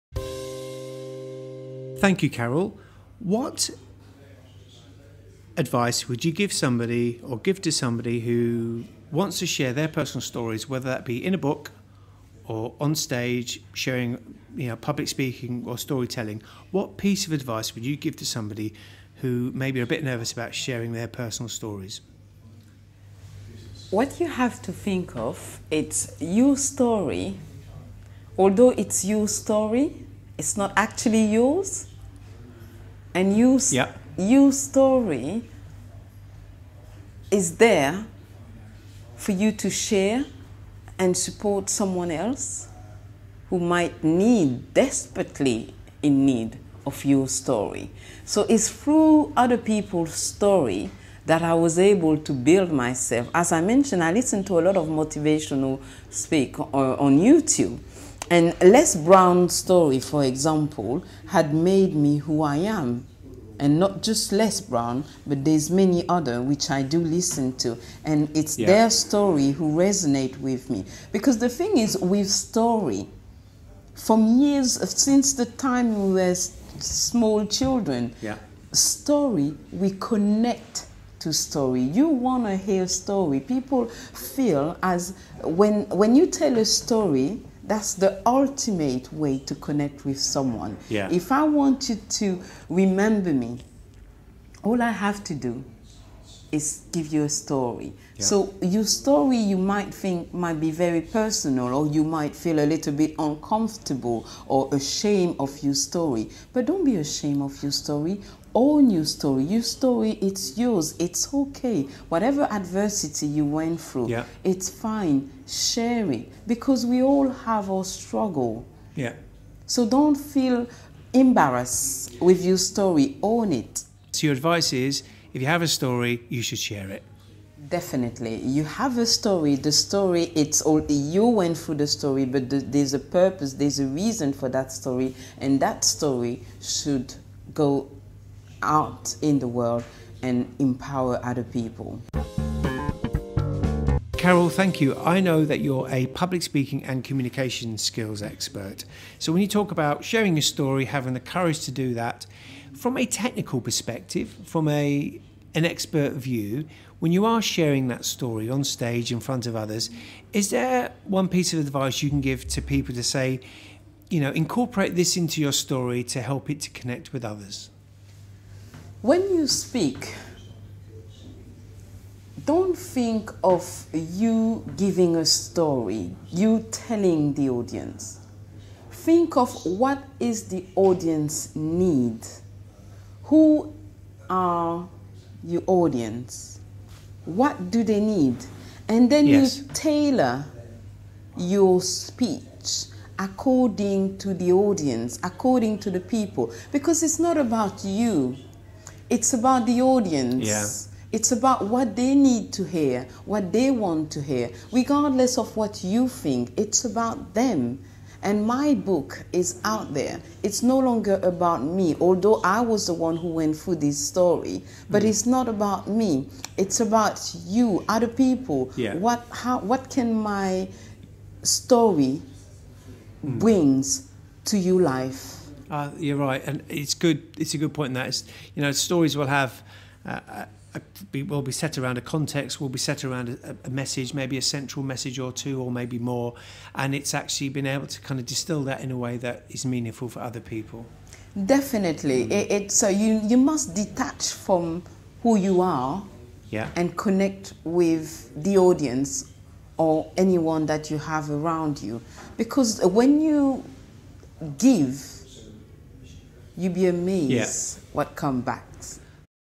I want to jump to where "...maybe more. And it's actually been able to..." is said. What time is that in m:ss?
3:55.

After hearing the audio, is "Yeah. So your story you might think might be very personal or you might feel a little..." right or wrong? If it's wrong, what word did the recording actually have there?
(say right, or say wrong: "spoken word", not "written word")
right.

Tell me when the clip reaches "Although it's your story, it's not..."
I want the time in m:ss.
0:28.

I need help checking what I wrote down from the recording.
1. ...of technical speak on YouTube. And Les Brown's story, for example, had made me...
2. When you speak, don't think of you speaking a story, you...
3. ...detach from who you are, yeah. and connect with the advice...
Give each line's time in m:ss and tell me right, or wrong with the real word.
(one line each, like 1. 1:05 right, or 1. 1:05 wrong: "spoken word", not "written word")
1. 0:54 wrong: "motivational", not "technical"
2. 2:49 wrong: "giving", not "speaking"
3. 4:03 wrong: "audience", not "advice".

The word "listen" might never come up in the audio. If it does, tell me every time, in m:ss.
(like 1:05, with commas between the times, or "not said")
0:54, 1:07.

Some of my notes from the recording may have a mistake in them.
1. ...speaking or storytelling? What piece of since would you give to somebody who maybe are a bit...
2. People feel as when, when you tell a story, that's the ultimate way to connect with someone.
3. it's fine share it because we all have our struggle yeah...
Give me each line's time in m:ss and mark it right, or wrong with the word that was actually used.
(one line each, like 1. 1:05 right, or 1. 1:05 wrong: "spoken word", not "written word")
1. 0:15 wrong: "advice", not "since"
2. 1:23 right
3. 1:54 right.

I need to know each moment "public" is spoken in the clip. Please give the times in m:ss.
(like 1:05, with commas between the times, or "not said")
0:14, 2:26.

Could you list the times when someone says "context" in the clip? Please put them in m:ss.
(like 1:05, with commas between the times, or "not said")
3:52.